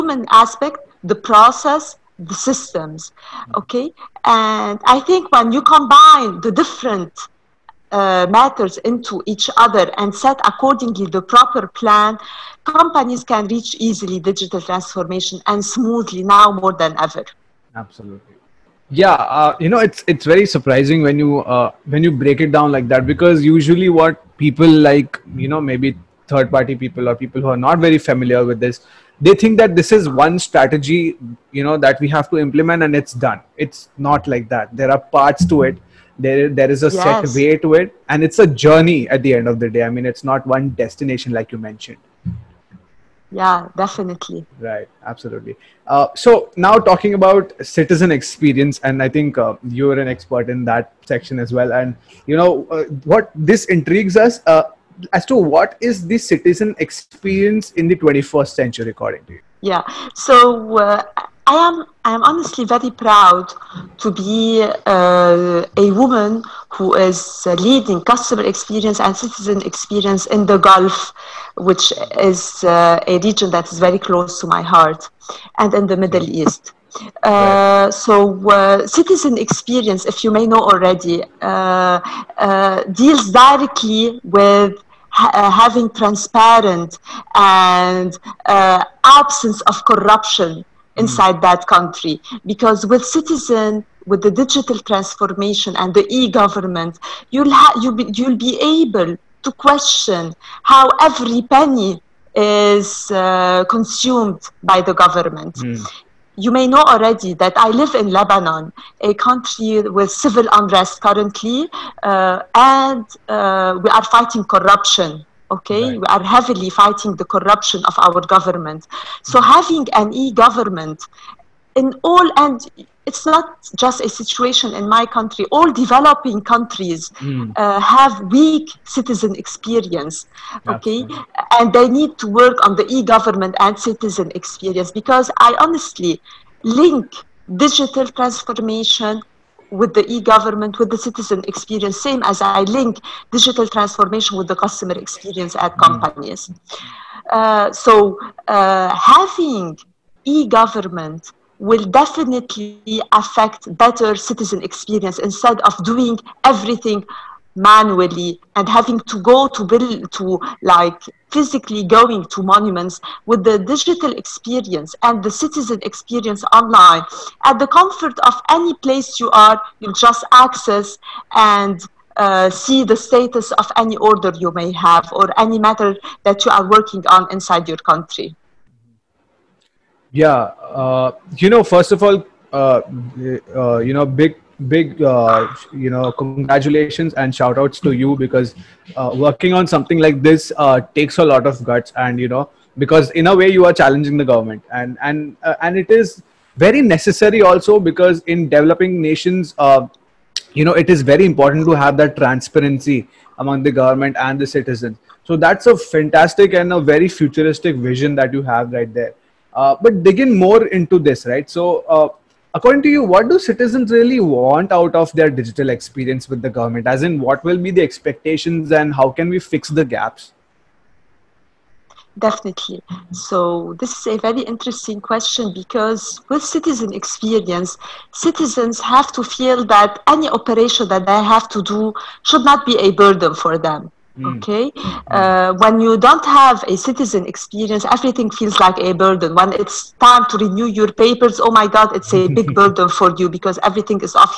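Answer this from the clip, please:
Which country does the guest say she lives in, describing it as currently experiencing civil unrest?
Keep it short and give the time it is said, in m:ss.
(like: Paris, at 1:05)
Lebanon, at 1:48.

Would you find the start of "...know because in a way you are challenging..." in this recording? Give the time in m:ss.
3:12.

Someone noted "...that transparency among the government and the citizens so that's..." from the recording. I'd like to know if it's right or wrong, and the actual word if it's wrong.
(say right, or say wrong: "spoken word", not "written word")
right.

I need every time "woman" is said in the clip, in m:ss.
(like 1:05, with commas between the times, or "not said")
1:05.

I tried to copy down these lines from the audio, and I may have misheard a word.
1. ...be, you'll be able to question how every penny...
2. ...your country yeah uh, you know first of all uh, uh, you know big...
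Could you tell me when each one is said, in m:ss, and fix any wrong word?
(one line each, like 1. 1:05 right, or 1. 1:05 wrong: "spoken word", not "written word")
1. 1:38 right
2. 2:57 right.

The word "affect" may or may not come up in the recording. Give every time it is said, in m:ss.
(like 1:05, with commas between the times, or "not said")
2:33.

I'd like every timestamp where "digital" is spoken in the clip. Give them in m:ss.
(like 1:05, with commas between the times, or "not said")
0:14, 1:34, 2:17, 2:23, 2:43, 3:35.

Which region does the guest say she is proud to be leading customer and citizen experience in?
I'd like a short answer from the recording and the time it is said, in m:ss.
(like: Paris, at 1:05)
the Gulf, at 1:10.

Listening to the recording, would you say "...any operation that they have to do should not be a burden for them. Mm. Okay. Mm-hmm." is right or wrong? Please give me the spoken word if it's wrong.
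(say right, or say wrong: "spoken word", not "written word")
right.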